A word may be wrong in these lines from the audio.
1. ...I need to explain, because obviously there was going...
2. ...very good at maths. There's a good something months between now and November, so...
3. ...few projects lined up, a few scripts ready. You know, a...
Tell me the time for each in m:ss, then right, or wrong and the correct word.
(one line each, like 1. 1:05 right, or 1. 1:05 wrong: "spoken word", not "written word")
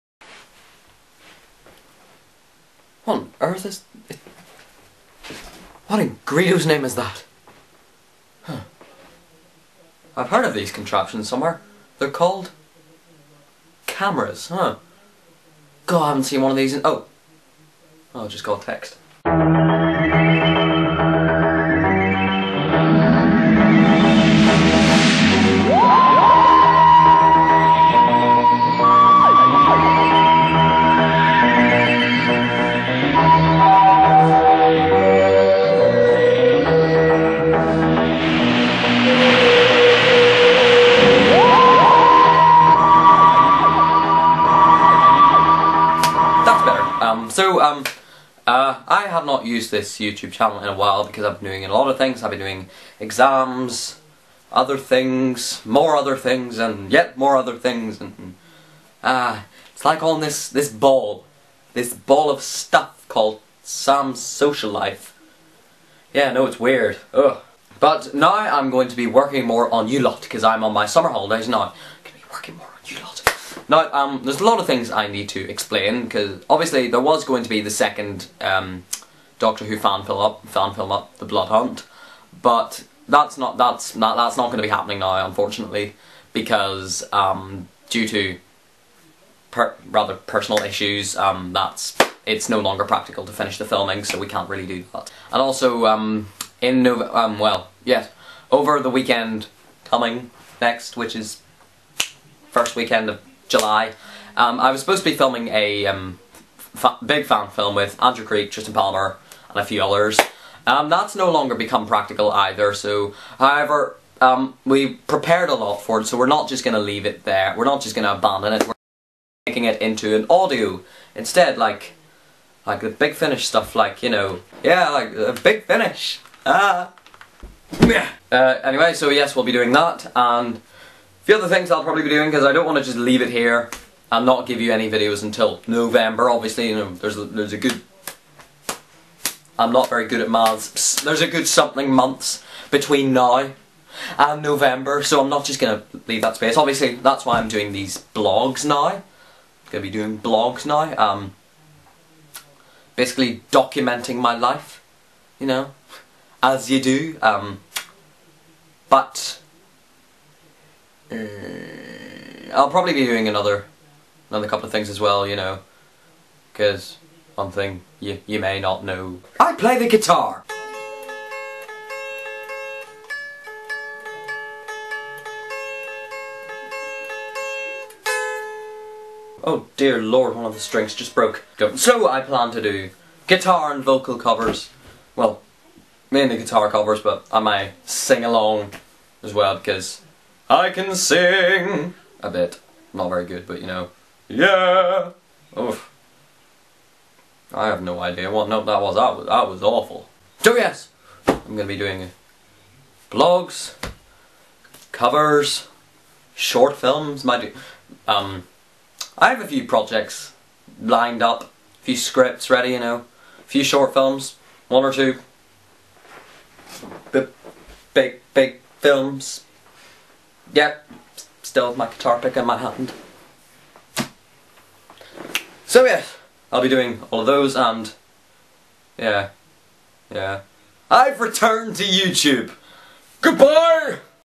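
1. 1:14 right
2. 2:19 right
3. 3:29 right.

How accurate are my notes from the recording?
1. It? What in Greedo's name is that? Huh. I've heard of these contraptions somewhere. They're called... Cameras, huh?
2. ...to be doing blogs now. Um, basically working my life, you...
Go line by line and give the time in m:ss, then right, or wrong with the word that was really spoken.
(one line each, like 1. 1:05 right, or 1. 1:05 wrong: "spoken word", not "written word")
1. 0:04 right
2. 2:29 wrong: "documenting", not "working".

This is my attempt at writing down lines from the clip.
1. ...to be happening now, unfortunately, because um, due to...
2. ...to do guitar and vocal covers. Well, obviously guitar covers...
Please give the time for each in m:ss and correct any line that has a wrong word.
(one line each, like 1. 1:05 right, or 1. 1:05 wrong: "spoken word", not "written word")
1. 1:24 right
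2. 3:02 wrong: "mainly", not "obviously".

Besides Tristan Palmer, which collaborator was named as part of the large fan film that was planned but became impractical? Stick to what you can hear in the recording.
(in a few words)
Andrew Creek.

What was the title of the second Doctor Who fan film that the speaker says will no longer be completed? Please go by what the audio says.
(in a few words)
The Blood Hunt.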